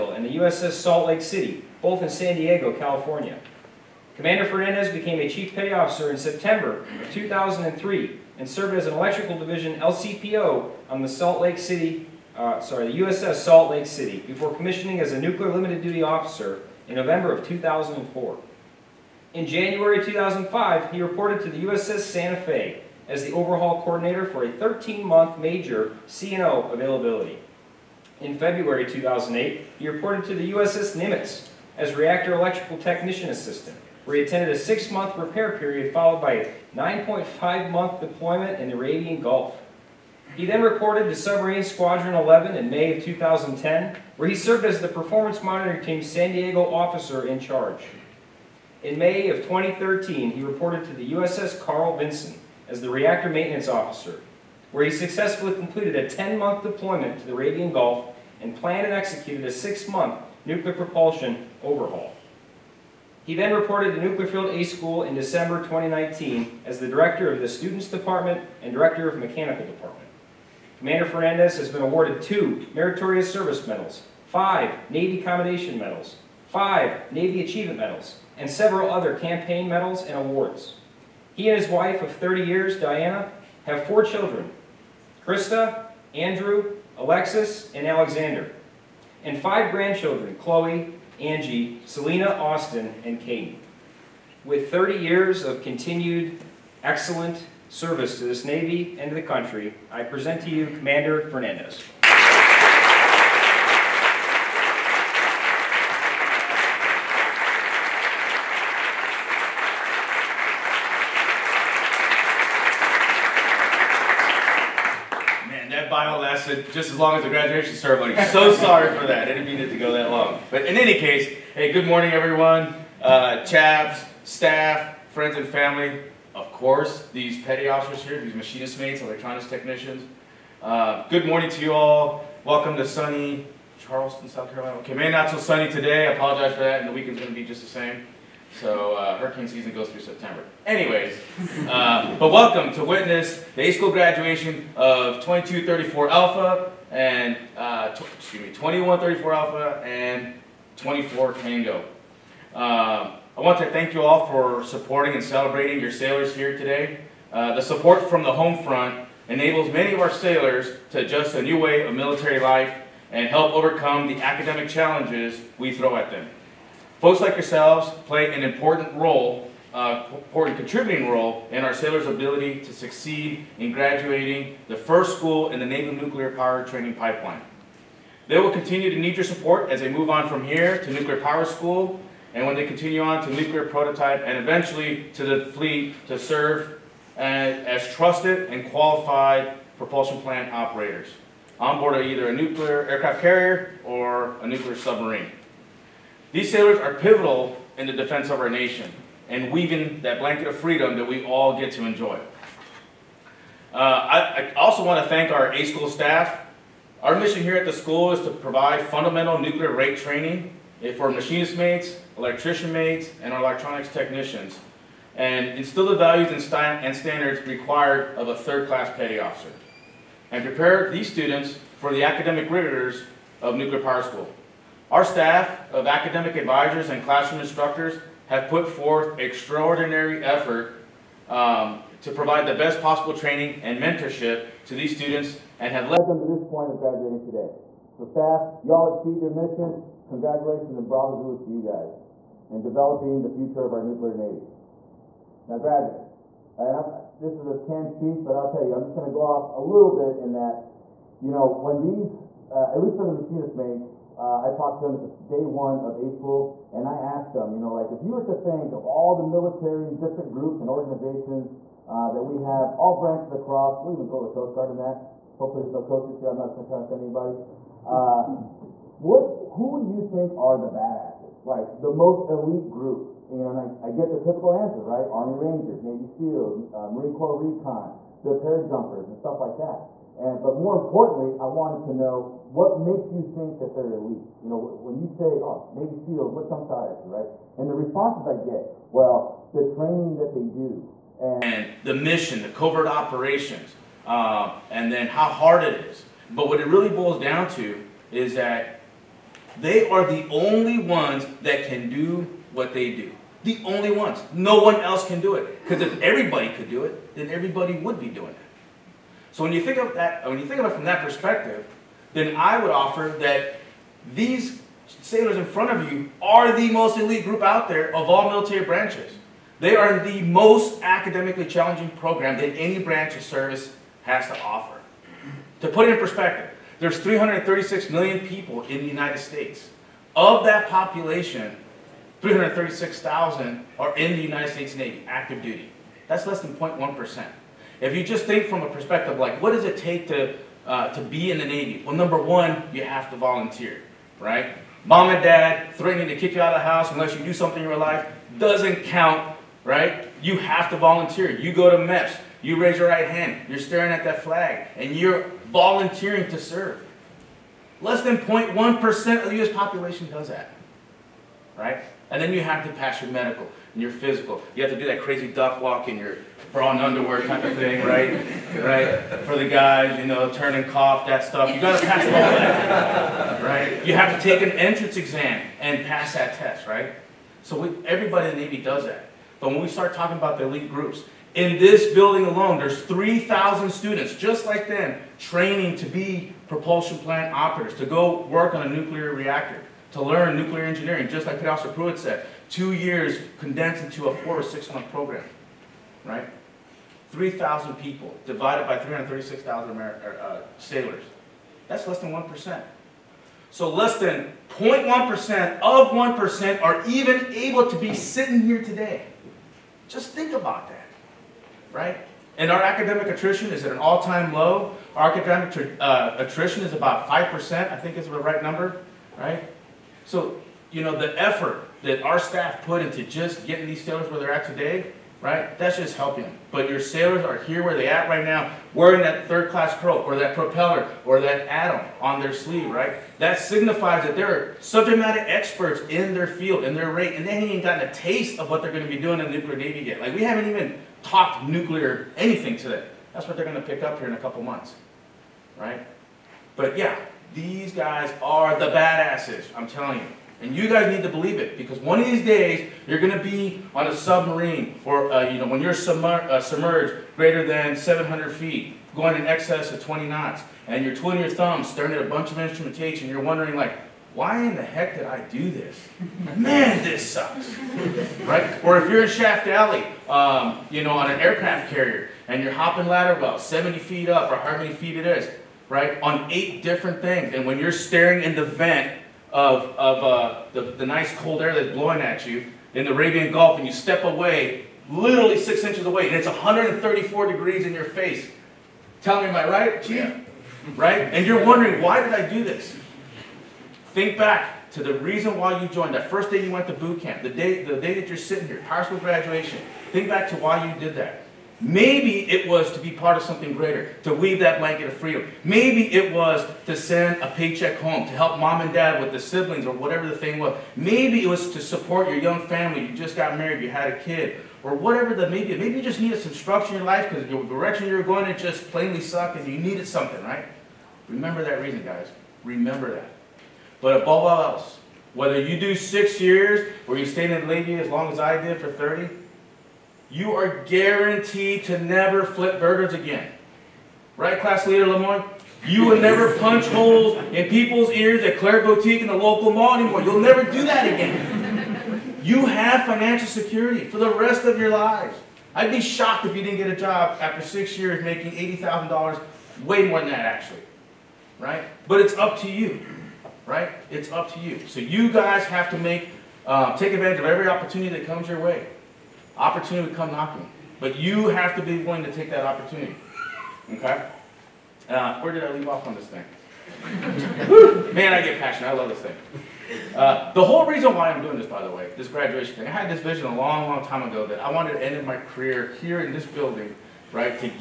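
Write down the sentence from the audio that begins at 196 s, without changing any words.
These sailors are pivotal in the defense of our nation and weaving that blanket of freedom that we all get to enjoy.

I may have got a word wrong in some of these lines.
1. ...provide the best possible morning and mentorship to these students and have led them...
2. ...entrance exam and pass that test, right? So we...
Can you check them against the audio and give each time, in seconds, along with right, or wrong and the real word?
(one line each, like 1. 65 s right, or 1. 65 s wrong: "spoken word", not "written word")
1. 232 s wrong: "training", not "morning"
2. 374 s right.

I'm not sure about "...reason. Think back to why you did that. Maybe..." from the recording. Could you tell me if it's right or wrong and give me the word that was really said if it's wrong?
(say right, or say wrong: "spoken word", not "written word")
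wrong: "graduation", not "reason".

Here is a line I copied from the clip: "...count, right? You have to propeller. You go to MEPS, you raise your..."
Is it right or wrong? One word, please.
wrong.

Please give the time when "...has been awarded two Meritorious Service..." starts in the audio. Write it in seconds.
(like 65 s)
71 s.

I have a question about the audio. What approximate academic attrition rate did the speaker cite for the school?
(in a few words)
5%.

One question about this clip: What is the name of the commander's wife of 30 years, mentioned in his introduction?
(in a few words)
Diana.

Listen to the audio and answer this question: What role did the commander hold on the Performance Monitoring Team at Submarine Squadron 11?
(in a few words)
San Diego officer in charge.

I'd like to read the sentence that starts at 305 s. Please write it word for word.
Because if everybody could do it, then everybody would be doing it.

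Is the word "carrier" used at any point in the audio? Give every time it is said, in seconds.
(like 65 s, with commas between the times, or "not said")
193 s, 471 s.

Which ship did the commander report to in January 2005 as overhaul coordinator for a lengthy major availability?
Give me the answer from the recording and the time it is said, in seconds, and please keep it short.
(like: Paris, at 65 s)
USS Santa Fe, at 21 s.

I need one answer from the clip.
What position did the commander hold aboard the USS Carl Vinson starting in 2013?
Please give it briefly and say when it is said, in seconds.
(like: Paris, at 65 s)
reactor maintenance officer, at 52 s.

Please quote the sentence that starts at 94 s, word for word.
With 30 years of continued excellent service to this Navy and to the country, I present to you Commander Fernandez.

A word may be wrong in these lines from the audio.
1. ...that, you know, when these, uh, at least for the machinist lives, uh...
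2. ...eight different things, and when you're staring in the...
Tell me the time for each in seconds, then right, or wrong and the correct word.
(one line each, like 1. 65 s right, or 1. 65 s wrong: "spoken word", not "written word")
1. 250 s wrong: "mates", not "lives"
2. 476 s right.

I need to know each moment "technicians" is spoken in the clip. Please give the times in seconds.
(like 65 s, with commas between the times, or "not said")
32 s, 129 s, 213 s.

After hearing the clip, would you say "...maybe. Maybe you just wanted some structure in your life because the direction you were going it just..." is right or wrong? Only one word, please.
wrong.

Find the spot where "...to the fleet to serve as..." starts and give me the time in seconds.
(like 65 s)
185 s.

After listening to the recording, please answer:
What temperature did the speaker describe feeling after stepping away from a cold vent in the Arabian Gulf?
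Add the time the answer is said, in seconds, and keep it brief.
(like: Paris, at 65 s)
134 degrees, at 486 s.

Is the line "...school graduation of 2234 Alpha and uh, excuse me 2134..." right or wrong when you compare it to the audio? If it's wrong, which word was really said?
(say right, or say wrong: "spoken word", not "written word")
right.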